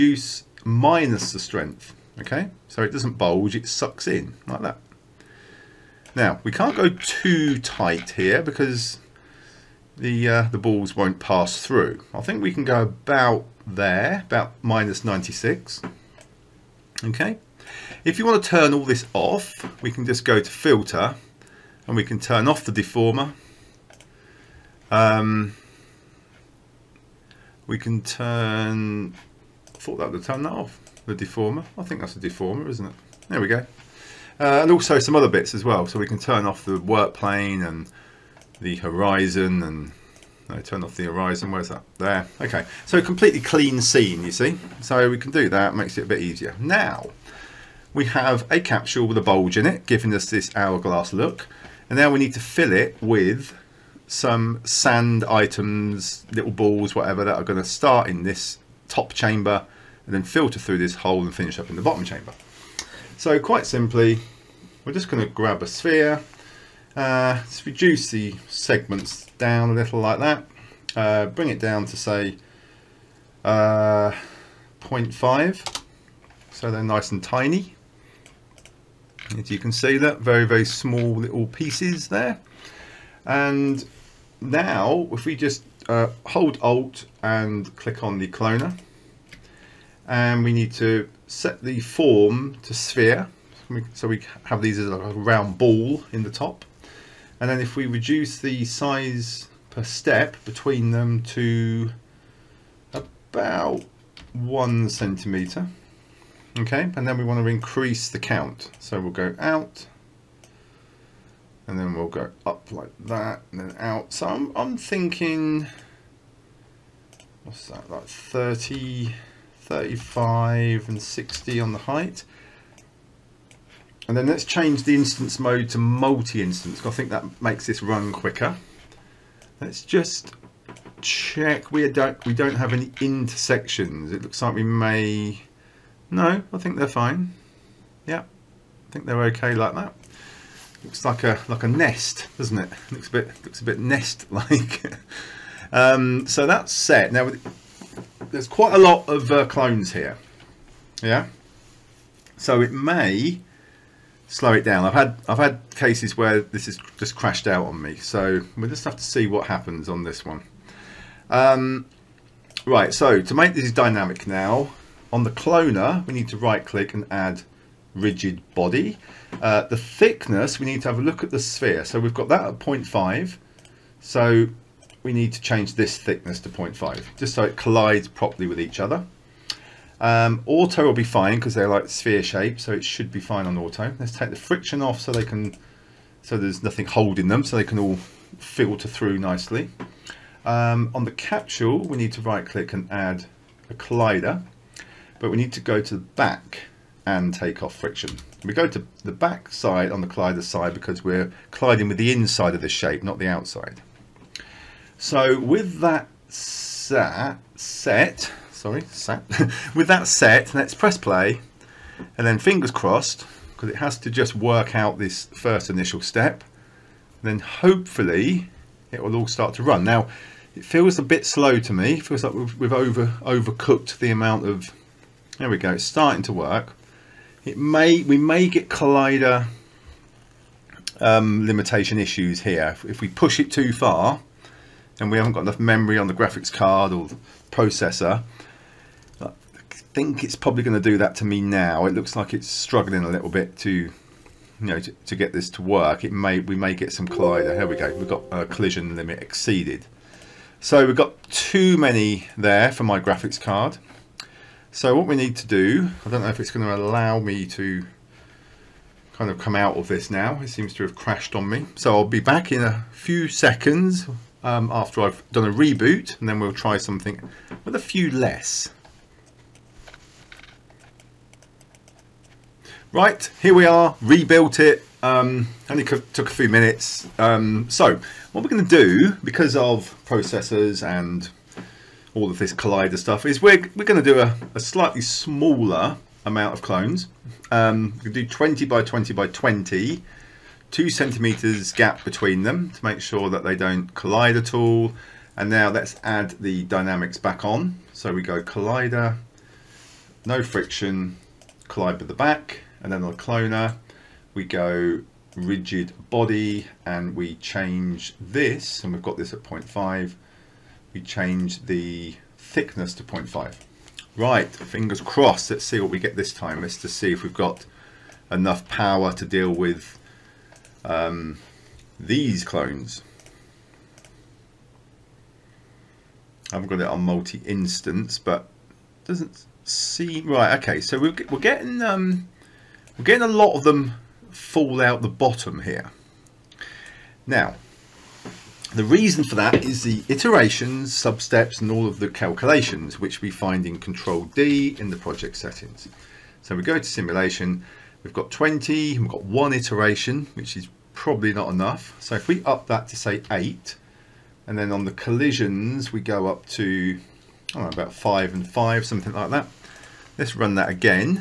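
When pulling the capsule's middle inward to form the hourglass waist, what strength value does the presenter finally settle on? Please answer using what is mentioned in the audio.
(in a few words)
-96.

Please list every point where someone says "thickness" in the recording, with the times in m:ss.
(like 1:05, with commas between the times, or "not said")
2:49, 2:55, 5:12.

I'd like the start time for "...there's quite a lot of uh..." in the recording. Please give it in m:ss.
2:28.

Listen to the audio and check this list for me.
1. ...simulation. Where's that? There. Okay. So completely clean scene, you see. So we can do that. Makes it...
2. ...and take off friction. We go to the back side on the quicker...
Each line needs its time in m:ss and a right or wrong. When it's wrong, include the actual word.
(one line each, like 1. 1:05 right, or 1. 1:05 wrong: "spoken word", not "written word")
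1. 0:41 wrong: "horizon", not "simulation"
2. 3:17 wrong: "collider", not "quicker".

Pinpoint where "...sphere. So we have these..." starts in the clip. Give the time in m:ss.
1:32.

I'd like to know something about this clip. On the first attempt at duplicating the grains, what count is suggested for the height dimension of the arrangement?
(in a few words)
60.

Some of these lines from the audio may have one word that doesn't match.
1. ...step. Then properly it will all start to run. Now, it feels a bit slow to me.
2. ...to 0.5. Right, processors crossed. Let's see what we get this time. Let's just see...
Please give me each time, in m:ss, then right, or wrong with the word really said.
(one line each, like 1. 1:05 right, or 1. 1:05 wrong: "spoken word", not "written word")
1. 3:36 wrong: "hopefully", not "properly"
2. 5:12 wrong: "fingers", not "processors".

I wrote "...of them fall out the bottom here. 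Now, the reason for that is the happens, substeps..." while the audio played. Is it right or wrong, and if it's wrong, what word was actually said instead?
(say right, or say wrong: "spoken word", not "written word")
wrong: "iterations", not "happens".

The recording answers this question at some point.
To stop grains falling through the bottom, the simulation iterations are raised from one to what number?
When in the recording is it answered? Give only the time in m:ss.
5:53.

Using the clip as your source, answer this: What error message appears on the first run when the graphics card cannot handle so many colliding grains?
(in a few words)
Collision limit exceeded.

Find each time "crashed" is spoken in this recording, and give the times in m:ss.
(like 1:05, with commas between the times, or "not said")
2:37, 4:20.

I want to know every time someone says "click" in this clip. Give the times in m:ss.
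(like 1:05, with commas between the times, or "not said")
1:27, 2:46, 3:12.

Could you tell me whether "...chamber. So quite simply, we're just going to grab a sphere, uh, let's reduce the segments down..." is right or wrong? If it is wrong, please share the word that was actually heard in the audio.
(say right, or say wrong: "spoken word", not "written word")
right.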